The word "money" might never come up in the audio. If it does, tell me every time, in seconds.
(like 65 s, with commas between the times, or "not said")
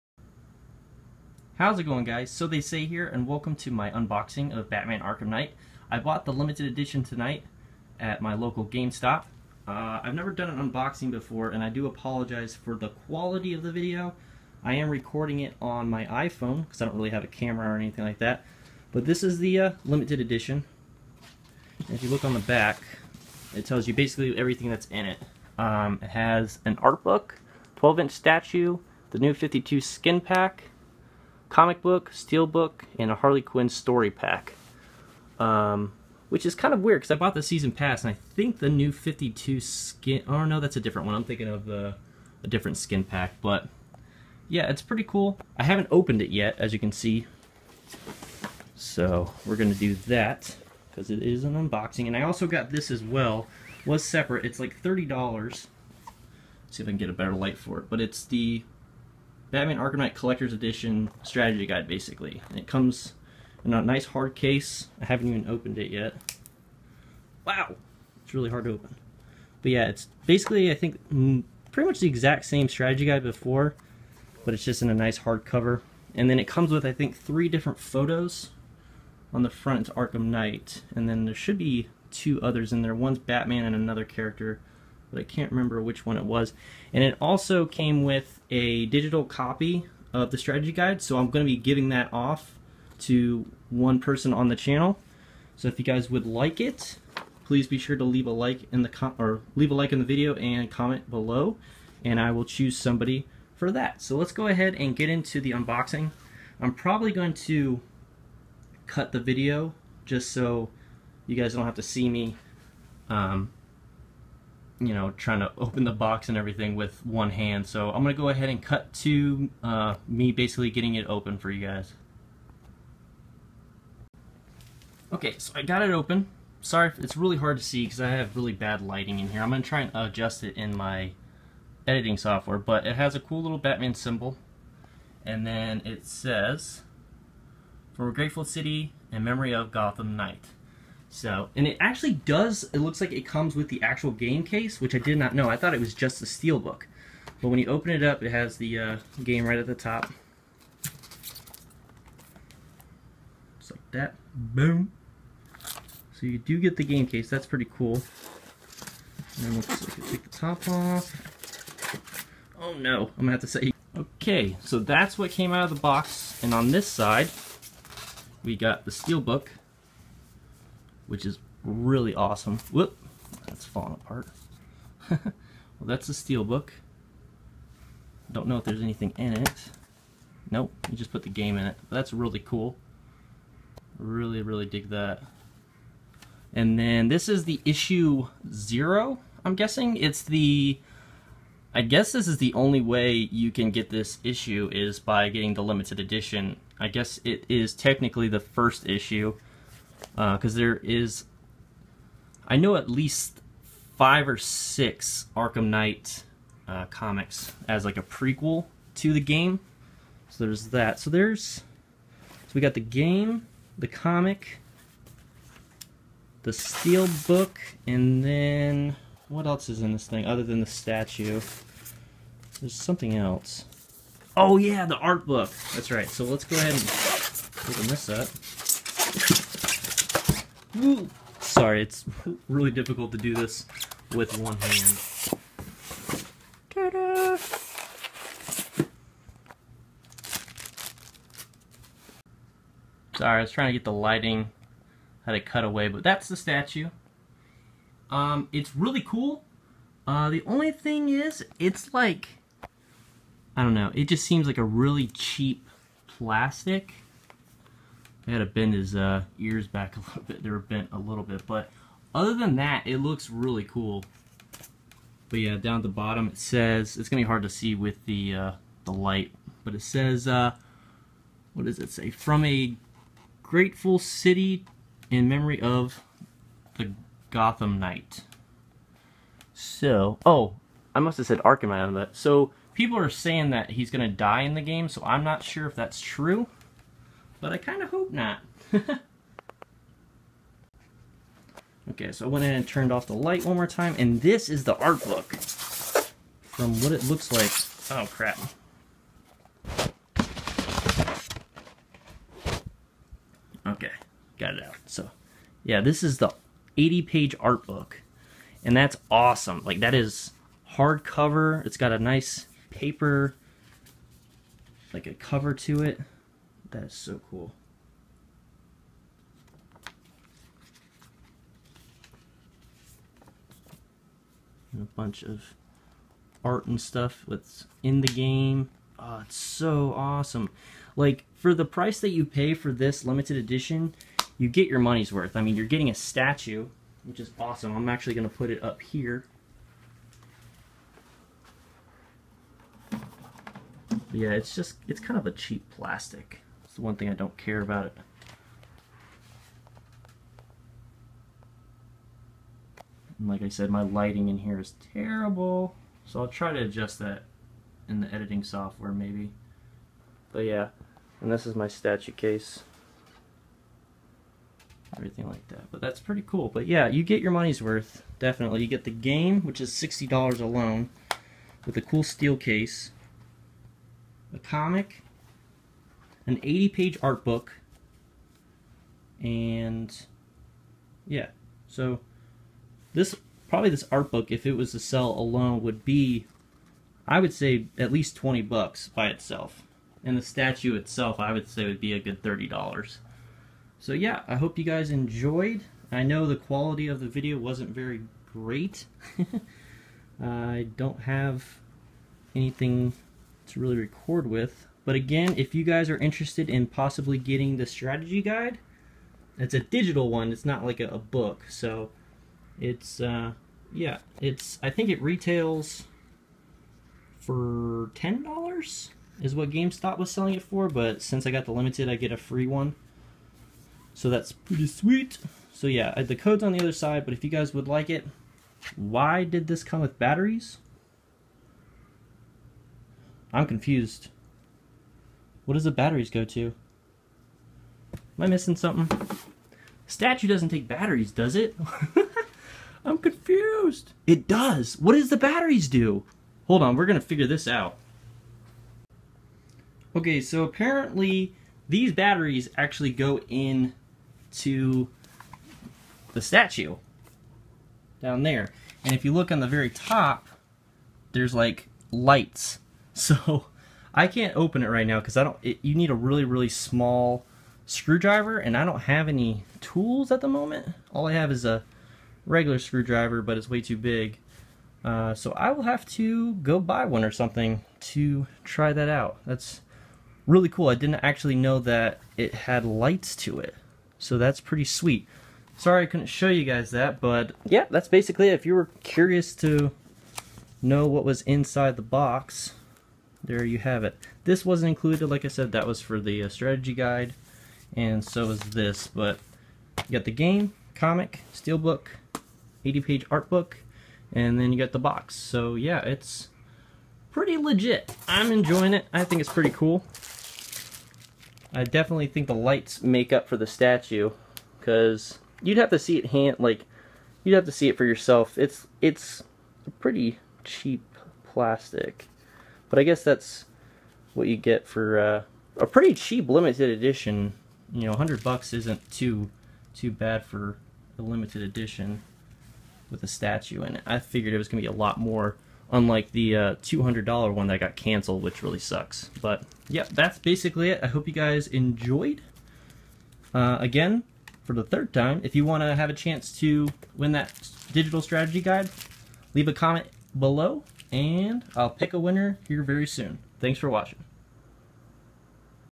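334 s, 367 s.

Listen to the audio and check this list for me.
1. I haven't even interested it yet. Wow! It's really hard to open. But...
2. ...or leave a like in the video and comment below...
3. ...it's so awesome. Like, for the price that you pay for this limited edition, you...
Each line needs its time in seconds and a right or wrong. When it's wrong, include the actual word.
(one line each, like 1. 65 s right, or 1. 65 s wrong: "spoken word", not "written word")
1. 65 s wrong: "opened", not "interested"
2. 99 s right
3. 329 s right.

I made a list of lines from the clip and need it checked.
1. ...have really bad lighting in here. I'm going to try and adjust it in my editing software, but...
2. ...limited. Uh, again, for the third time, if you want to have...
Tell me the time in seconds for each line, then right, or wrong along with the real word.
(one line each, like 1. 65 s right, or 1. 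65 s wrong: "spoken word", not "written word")
1. 128 s right
2. 541 s wrong: "enjoyed", not "limited".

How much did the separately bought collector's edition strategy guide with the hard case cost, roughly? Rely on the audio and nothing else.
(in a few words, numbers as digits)
$30.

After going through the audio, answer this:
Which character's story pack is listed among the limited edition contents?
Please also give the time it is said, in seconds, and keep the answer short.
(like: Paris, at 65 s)
Harley Quinn, at 33 s.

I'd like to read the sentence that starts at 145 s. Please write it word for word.
I thought it was just the steelbook.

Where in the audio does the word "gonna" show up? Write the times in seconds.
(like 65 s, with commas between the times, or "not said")
49 s, 163 s.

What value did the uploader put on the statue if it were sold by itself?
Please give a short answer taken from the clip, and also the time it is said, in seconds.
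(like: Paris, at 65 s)
$30, at 392 s.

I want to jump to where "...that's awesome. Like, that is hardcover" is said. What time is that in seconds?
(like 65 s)
308 s.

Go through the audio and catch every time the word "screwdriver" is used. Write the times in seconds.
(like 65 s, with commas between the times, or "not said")
467 s, 472 s.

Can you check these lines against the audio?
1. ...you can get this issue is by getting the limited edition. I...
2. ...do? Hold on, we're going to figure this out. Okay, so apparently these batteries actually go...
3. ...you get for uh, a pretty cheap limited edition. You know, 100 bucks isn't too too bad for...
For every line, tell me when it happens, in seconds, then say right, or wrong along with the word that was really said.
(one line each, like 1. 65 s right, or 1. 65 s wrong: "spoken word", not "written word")
1. 193 s right
2. 445 s right
3. 524 s right.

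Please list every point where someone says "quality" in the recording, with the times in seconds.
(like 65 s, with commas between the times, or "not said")
12 s, 396 s.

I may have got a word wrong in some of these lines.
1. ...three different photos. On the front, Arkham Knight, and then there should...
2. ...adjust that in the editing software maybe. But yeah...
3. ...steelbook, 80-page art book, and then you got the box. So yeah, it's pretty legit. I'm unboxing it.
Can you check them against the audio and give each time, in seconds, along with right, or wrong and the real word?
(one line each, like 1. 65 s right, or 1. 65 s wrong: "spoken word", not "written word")
1. 77 s right
2. 356 s right
3. 501 s wrong: "enjoying", not "unboxing".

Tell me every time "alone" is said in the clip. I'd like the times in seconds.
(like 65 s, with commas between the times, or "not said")
370 s, 385 s.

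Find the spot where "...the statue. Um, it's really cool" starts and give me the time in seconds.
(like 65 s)
246 s.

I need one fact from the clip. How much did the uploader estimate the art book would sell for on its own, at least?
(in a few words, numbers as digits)
$20.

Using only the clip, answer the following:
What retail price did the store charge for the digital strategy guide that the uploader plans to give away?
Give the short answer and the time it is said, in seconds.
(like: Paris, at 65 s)
$10, at 417 s.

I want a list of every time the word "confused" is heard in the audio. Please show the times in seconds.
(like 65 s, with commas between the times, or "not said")
433 s, 442 s.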